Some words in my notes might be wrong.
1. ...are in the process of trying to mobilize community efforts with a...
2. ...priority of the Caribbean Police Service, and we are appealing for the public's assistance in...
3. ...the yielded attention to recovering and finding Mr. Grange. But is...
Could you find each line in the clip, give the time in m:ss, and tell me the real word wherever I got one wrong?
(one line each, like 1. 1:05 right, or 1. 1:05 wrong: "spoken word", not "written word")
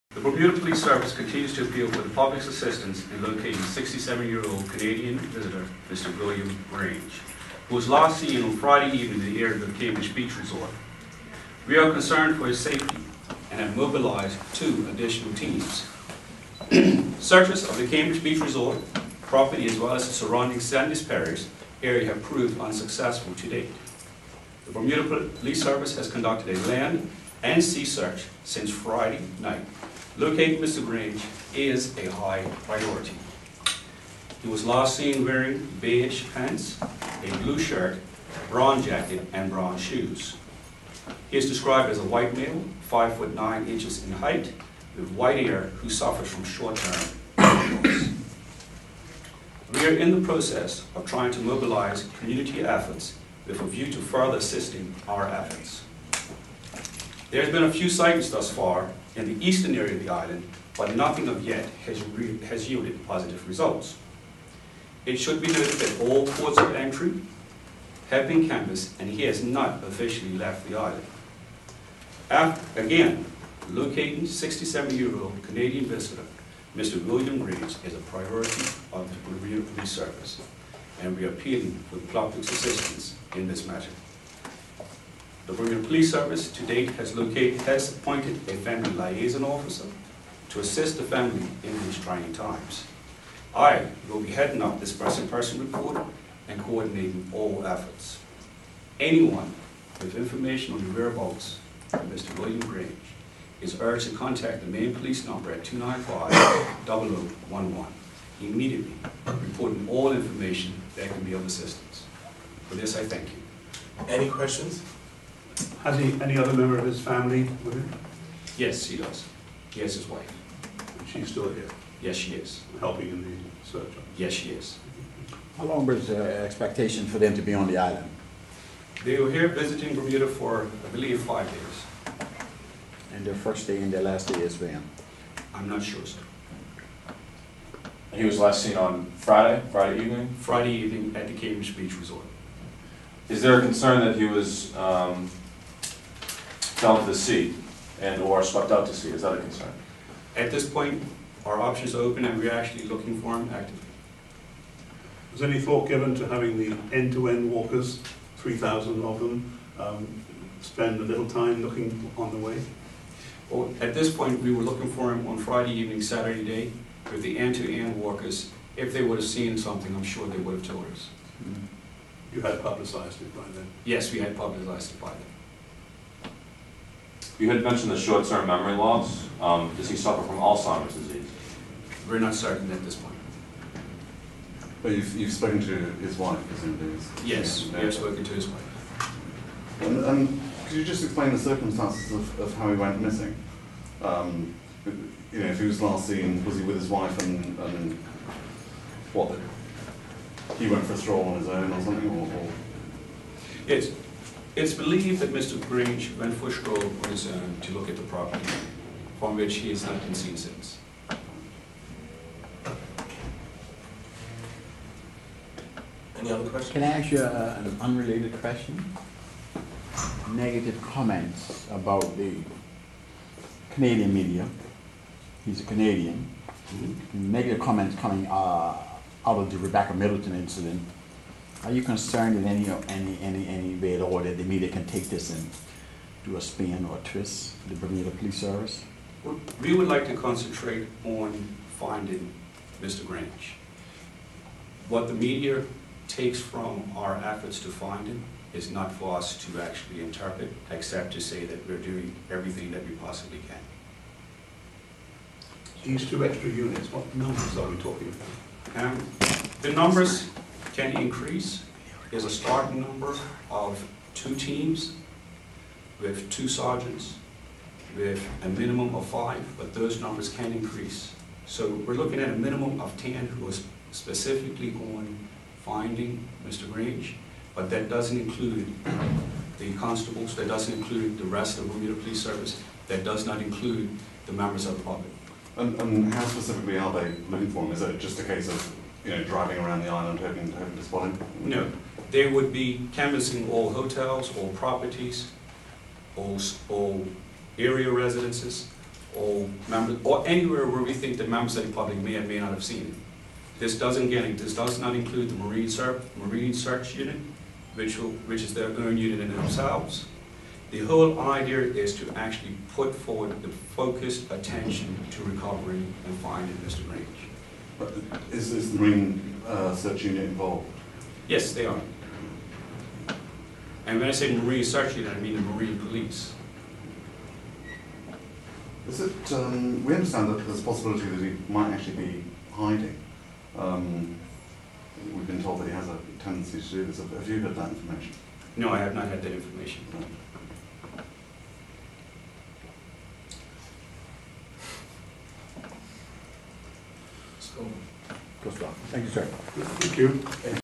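1. 0:49 right
2. 1:18 right
3. 5:13 wrong: "focused", not "yielded".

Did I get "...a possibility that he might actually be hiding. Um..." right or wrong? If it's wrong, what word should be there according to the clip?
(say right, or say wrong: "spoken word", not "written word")
right.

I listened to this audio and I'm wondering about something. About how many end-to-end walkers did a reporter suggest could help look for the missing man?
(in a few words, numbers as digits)
3,000.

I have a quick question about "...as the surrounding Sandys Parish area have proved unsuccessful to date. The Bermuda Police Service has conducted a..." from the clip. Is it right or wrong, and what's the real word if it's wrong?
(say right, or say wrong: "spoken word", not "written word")
right.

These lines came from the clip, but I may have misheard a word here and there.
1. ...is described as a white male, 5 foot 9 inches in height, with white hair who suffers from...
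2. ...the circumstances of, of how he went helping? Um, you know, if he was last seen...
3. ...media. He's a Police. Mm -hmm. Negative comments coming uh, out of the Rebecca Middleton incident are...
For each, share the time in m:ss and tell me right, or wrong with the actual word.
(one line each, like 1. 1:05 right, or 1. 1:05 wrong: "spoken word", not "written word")
1. 0:41 right
2. 3:11 wrong: "missing", not "helping"
3. 3:44 wrong: "Canadian", not "Police".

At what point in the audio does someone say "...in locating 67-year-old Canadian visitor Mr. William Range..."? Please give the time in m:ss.
0:03.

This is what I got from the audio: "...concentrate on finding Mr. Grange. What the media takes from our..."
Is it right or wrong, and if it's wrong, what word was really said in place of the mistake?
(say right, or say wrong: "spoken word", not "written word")
right.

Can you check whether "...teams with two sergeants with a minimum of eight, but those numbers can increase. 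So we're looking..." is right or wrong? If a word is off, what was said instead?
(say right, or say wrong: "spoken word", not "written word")
wrong: "five", not "eight".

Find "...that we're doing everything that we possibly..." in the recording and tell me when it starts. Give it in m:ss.
4:11.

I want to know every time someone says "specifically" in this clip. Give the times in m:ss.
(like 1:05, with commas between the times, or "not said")
4:33, 4:46.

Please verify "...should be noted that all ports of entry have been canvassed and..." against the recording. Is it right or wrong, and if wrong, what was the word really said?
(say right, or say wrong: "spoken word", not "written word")
right.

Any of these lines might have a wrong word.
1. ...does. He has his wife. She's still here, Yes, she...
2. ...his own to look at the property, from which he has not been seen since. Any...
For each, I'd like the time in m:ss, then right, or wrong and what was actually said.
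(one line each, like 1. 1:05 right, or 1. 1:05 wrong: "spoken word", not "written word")
1. 1:58 right
2. 3:27 right.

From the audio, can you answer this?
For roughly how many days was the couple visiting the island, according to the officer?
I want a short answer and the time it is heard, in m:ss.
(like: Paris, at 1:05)
5, at 2:11.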